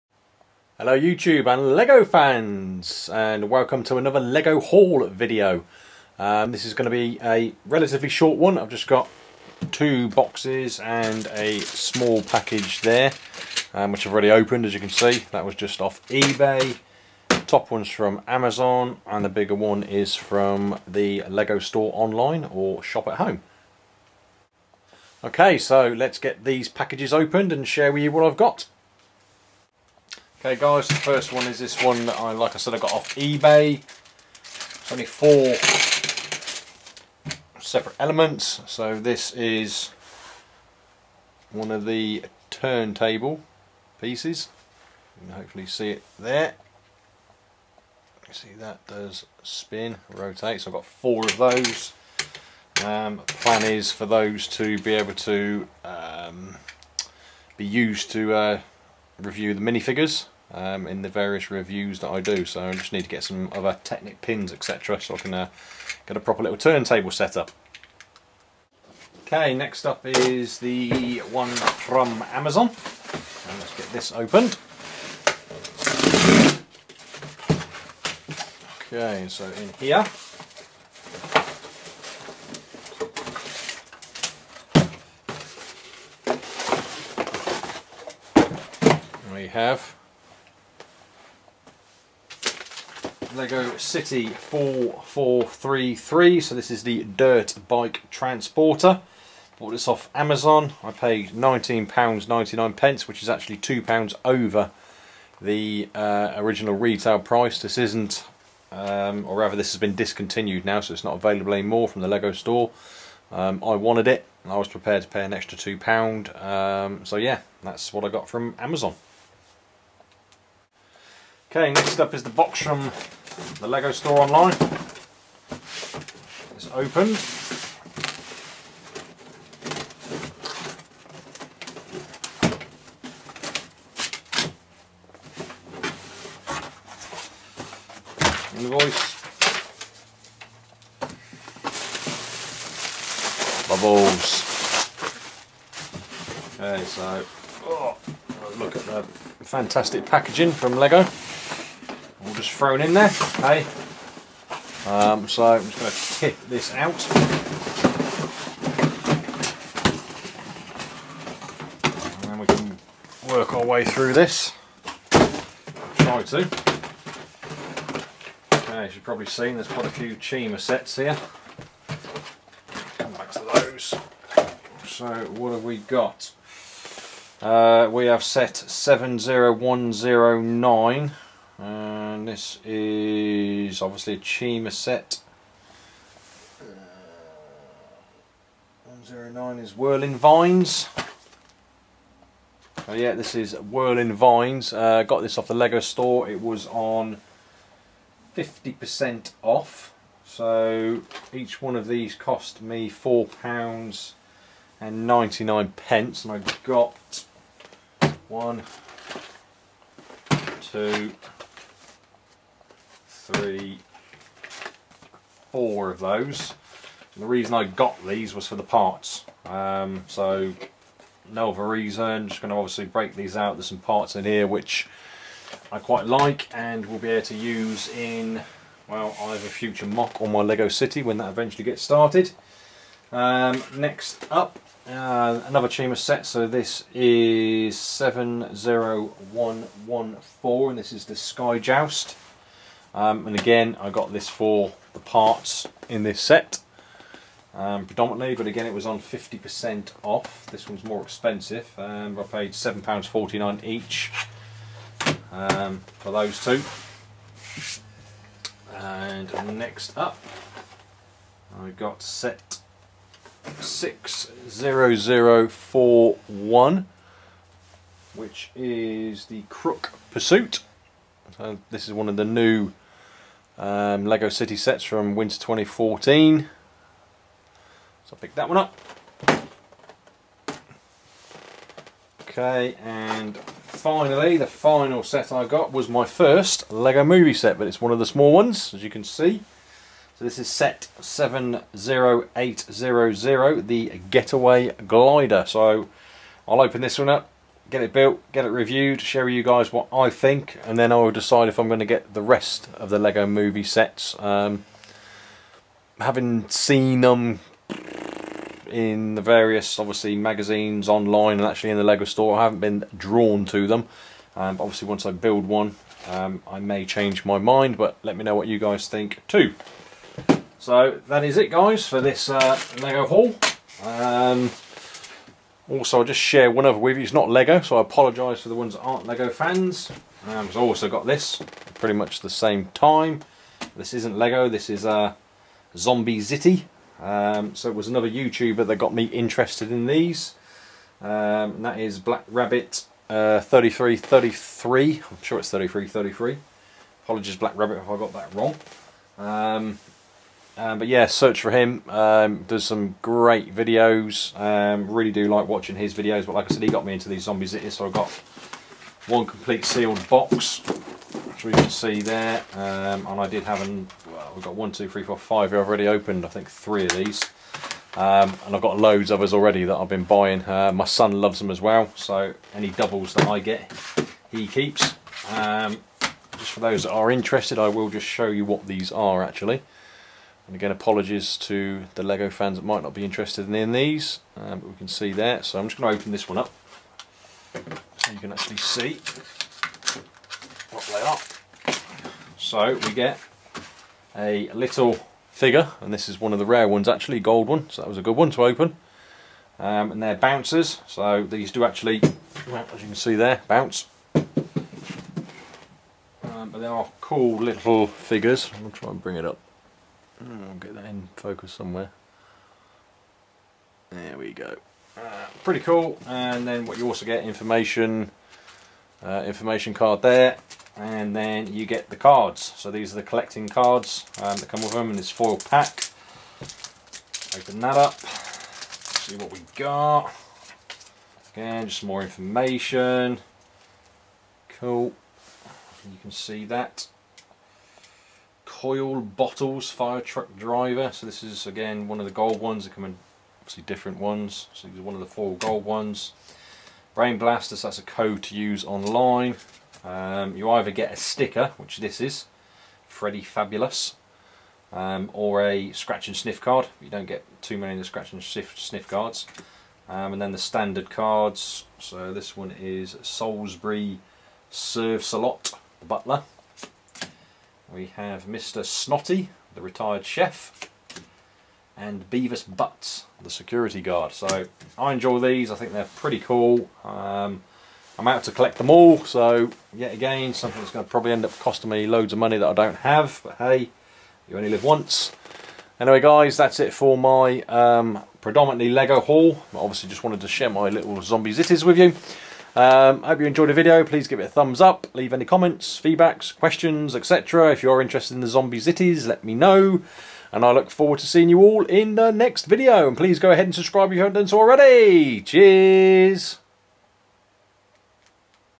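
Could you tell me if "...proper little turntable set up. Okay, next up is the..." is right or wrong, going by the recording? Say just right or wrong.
right.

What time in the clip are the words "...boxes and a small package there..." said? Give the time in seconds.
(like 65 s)
10 s.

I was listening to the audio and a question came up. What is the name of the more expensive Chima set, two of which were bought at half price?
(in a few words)
Sky Joust.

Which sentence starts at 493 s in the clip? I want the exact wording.
Please give it a thumbs up.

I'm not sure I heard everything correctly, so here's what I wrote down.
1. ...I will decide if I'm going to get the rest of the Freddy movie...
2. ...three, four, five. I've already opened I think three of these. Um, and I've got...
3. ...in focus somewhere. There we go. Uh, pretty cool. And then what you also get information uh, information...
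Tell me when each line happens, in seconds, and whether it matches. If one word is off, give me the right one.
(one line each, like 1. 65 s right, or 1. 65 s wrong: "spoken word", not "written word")
1. 300 s wrong: "Lego", not "Freddy"
2. 364 s right
3. 410 s right.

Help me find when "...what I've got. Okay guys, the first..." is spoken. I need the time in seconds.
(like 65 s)
28 s.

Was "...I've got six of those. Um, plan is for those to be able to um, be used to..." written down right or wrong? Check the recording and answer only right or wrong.
wrong.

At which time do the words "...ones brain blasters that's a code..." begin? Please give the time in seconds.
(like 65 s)
445 s.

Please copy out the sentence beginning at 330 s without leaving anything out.
Um, so also got this pretty much the same time.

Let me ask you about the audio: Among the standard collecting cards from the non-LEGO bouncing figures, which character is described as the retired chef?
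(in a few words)
Mr. Snotty.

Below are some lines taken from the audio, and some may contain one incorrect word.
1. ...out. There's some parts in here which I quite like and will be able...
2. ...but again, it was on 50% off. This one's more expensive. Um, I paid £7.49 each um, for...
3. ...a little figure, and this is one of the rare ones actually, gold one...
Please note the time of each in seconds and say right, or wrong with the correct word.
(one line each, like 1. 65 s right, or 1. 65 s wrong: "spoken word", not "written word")
1. 223 s right
2. 248 s right
3. 394 s right.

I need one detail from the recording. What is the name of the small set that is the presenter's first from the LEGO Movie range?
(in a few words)
Getaway Glider.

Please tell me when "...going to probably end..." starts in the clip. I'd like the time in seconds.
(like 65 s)
480 s.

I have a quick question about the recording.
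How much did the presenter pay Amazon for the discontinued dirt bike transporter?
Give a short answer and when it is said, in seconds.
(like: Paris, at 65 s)
£19.99, at 101 s.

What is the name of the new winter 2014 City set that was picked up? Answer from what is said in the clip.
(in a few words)
Crook Pursuit.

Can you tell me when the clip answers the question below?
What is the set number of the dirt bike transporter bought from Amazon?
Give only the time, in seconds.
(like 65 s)
94 s.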